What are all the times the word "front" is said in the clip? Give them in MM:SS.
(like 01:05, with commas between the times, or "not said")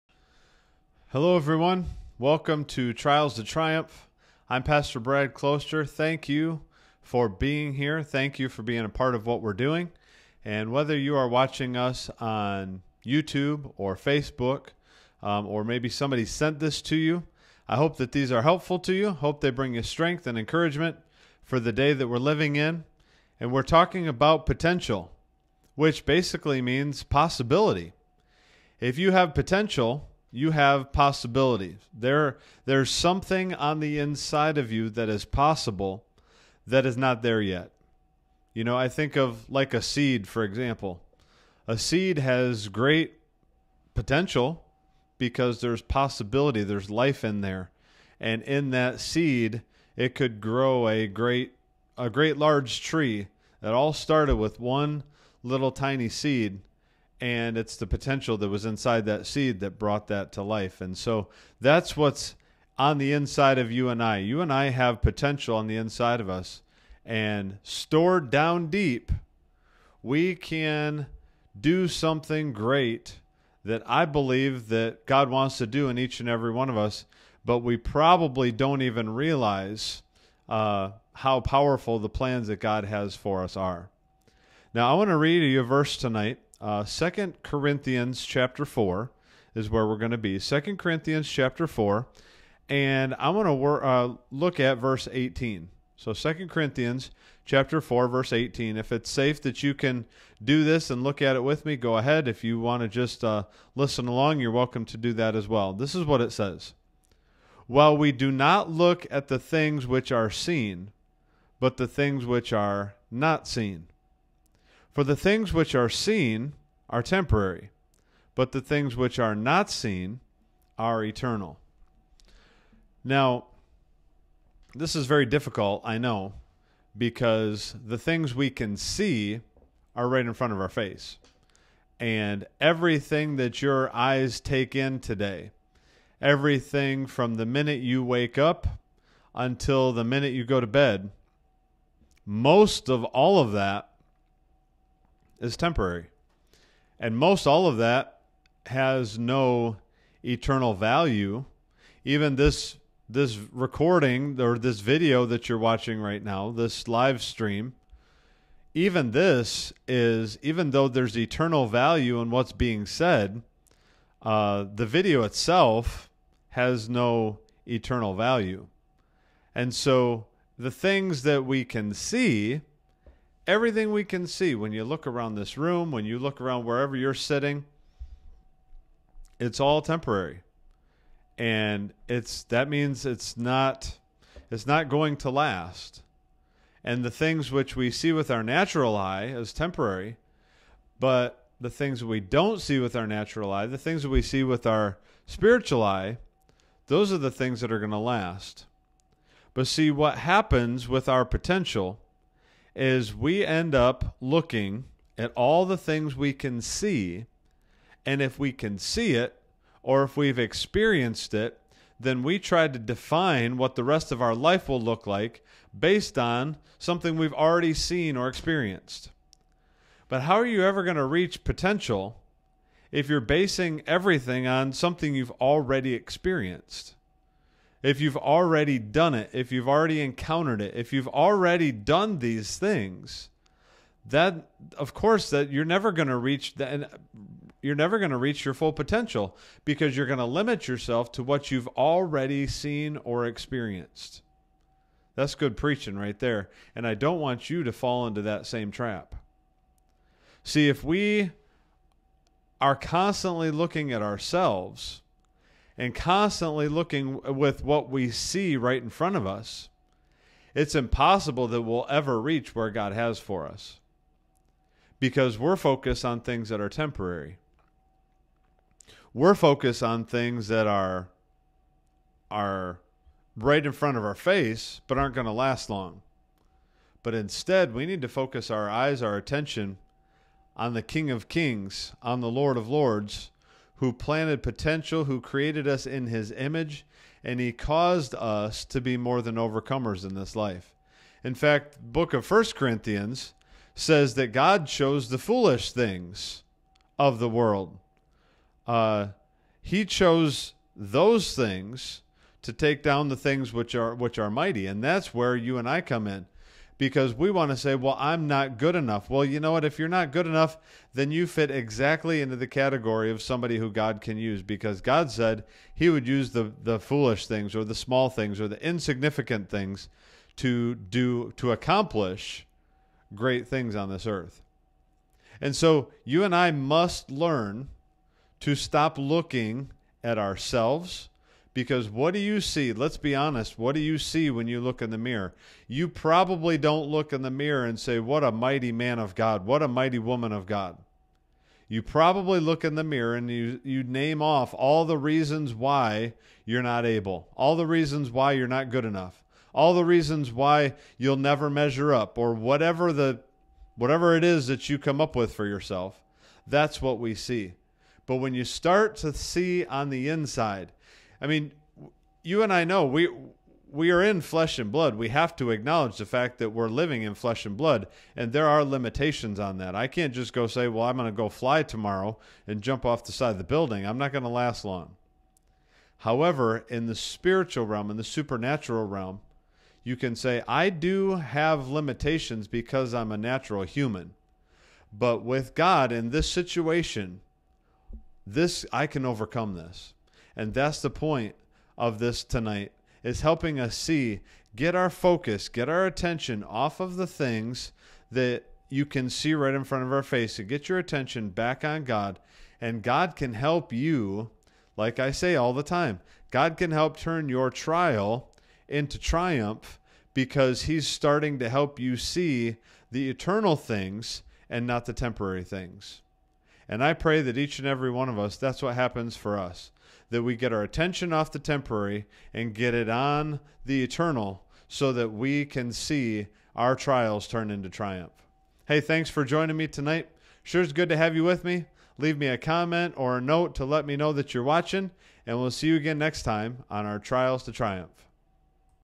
02:10, 04:18, 04:33, 06:39.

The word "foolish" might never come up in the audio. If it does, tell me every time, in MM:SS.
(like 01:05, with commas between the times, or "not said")
04:55, 05:16.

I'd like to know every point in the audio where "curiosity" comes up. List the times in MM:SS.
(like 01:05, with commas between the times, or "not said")
not said.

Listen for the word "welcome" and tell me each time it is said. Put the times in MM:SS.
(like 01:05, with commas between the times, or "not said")
00:02, 01:44.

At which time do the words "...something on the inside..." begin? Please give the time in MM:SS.
00:32.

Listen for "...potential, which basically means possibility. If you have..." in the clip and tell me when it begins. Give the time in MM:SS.
00:24.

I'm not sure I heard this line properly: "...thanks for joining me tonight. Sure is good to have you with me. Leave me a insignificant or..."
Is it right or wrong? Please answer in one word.
wrong.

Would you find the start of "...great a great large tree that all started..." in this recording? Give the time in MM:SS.
00:51.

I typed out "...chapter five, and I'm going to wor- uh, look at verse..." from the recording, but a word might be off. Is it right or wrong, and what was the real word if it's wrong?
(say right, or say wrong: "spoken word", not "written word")
wrong: "four", not "five".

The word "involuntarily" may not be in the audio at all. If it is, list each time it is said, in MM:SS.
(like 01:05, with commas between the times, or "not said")
not said.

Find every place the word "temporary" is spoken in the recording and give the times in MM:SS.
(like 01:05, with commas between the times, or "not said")
01:57, 02:25, 02:59, 03:09, 04:26, 06:54, 07:01.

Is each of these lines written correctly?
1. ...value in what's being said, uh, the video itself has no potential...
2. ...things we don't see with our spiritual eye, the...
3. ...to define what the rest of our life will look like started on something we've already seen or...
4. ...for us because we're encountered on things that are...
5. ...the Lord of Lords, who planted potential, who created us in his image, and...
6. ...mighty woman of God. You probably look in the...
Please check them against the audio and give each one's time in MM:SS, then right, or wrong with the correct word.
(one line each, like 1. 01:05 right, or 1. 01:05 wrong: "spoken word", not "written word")
1. 02:41 wrong: "eternal", not "potential"
2. 03:11 wrong: "natural", not "spiritual"
3. 03:32 wrong: "based", not "started"
4. 04:23 wrong: "focused", not "encountered"
5. 04:42 right
6. 05:39 right.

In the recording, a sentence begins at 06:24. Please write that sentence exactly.
But with God in this situation, this I can overcome this.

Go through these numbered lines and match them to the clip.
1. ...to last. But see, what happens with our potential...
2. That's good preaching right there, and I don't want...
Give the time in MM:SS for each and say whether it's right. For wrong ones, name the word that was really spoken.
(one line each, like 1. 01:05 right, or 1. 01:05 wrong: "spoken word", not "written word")
1. 03:17 right
2. 04:05 right.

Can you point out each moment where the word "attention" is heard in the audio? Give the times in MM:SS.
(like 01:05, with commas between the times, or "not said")
04:39, 06:35, 06:40, 07:00.